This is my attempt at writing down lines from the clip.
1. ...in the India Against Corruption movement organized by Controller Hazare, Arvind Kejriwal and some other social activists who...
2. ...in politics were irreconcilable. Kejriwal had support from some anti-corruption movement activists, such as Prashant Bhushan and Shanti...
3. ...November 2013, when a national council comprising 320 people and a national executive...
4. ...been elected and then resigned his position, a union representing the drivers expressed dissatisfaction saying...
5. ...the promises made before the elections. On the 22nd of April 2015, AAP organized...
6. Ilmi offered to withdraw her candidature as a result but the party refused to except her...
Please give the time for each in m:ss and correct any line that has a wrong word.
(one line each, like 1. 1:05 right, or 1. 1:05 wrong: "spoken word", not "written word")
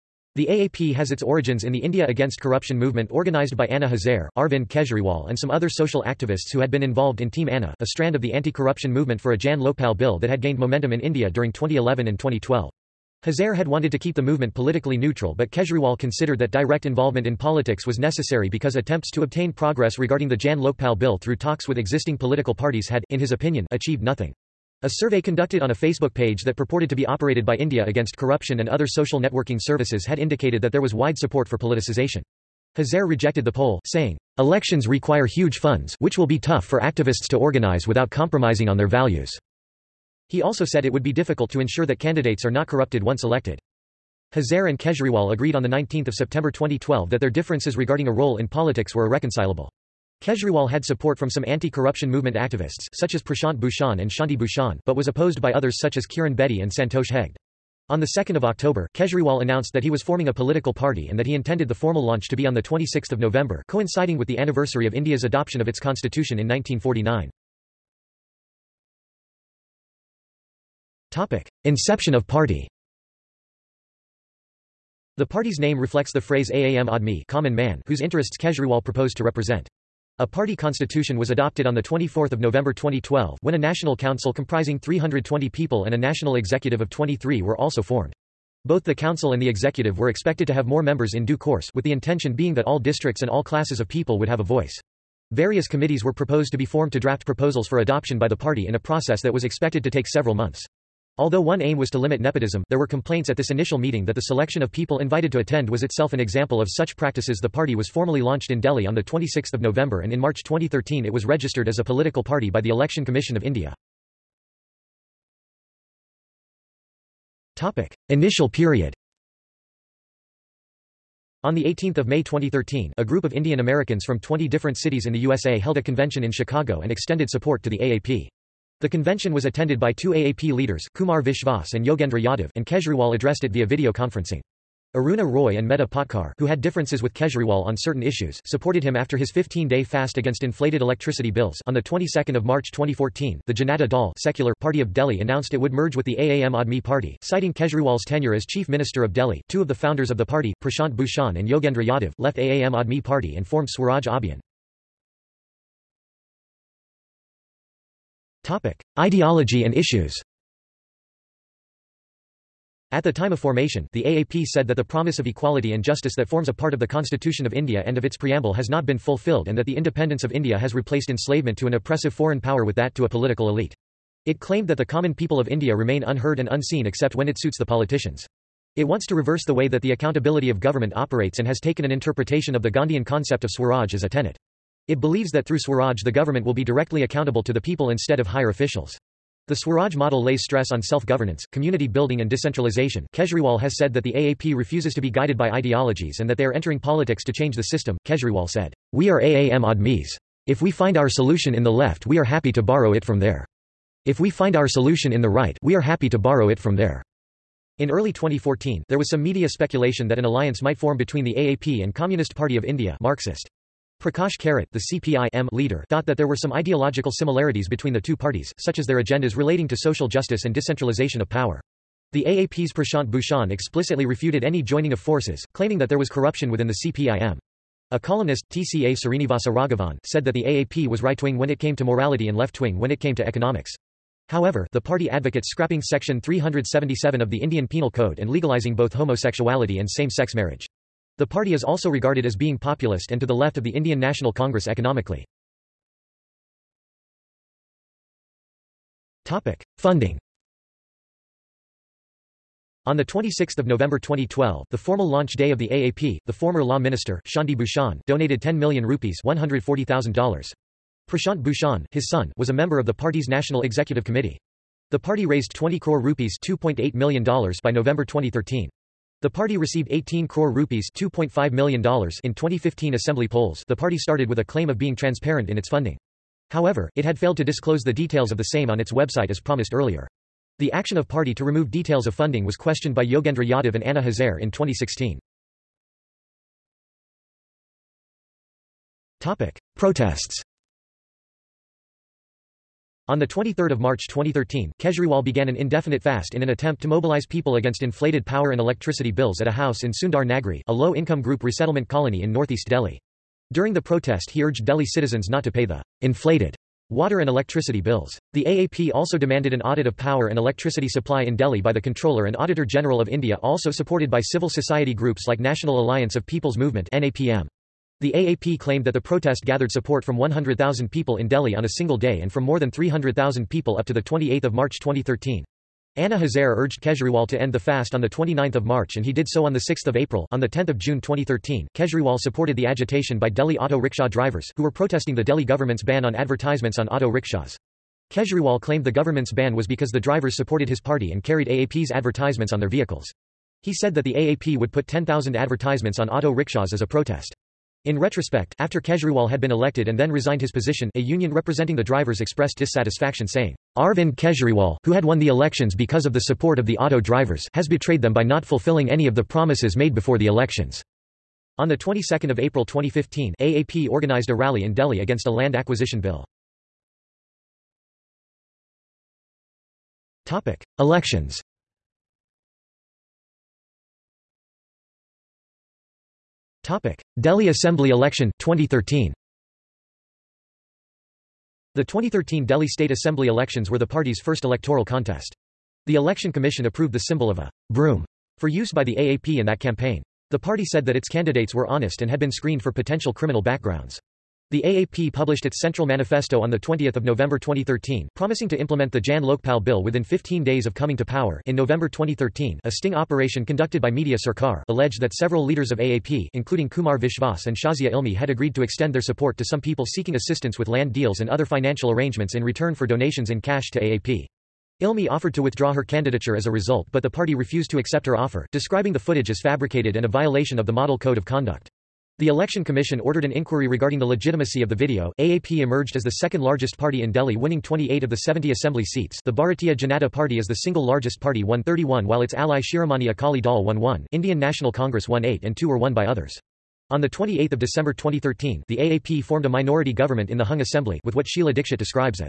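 1. 0:01 wrong: "Anna", not "Controller"
2. 0:48 right
3. 1:22 wrong: "2012", not "2013"
4. 5:49 right
5. 5:59 right
6. 6:54 wrong: "accept", not "except".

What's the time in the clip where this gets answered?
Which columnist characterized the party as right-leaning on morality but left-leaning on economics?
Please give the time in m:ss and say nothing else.
3:48.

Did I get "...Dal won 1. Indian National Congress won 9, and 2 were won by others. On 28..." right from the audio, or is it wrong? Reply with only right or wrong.
wrong.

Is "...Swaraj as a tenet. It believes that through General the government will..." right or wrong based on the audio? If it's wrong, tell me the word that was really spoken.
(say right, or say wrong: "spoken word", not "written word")
wrong: "Swaraj", not "General".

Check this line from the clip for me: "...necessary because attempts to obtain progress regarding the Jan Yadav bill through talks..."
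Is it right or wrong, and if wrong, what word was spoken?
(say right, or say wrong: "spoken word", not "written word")
wrong: "Lokpal", not "Yadav".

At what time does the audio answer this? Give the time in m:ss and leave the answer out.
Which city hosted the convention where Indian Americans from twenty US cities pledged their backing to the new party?
2:06.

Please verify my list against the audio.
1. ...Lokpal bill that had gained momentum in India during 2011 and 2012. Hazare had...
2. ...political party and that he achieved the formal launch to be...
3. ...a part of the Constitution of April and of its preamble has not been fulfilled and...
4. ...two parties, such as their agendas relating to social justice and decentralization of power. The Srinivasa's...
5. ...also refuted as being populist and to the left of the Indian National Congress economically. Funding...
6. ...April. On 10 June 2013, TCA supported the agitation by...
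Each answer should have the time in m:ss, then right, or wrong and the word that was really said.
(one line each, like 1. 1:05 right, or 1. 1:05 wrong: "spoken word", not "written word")
1. 0:09 right
2. 1:00 wrong: "intended", not "achieved"
3. 2:46 wrong: "India", not "April"
4. 3:37 wrong: "AAP", not "Srinivasa"
5. 4:01 wrong: "regarded", not "refuted"
6. 5:29 wrong: "Kejriwal", not "TCA".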